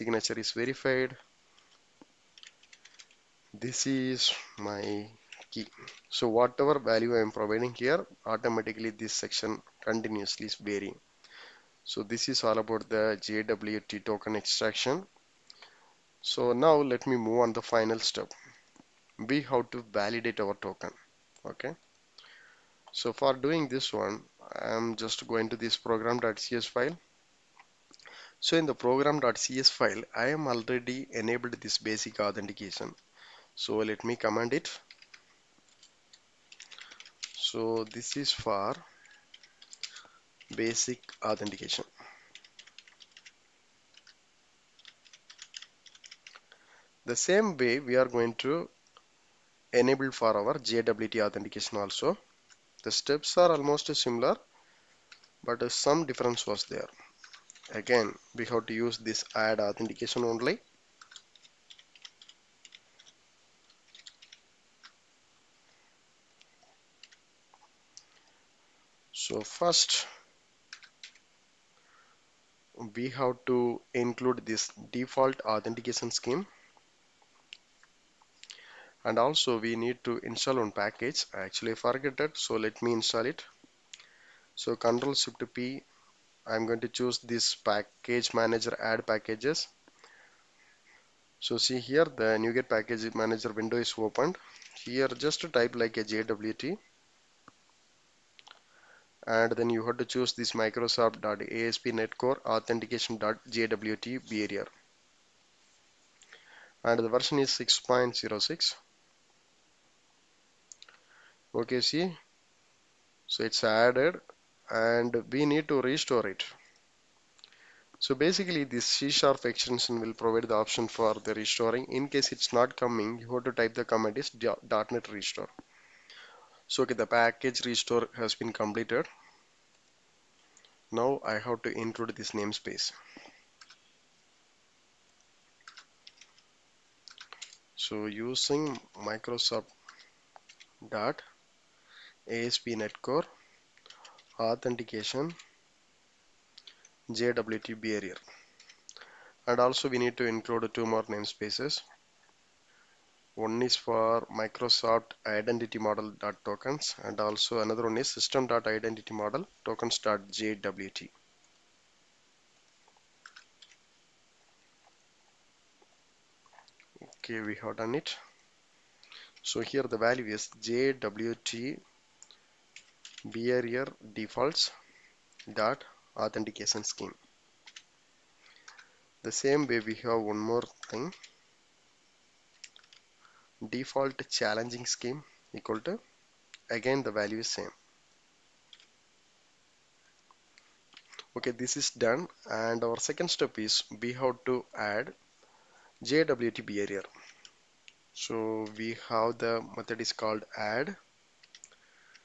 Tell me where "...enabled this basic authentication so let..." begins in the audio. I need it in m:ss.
0:31.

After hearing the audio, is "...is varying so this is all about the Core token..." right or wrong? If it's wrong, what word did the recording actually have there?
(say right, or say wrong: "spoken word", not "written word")
wrong: "JWT", not "Core".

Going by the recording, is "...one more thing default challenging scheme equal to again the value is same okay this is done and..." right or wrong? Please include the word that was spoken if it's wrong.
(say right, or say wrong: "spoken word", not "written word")
right.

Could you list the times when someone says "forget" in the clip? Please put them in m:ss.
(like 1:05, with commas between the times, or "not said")
1:21.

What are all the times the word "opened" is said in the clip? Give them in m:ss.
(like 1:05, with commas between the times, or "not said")
1:33.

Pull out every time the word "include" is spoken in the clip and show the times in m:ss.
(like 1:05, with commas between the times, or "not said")
1:14, 2:11, 2:30.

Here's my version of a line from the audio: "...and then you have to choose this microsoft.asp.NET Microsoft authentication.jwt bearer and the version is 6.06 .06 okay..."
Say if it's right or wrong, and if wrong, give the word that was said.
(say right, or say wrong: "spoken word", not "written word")
wrong: "Core", not "Microsoft".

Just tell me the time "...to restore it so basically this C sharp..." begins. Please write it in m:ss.
1:55.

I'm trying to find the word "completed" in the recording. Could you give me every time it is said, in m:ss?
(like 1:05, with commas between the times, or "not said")
2:08.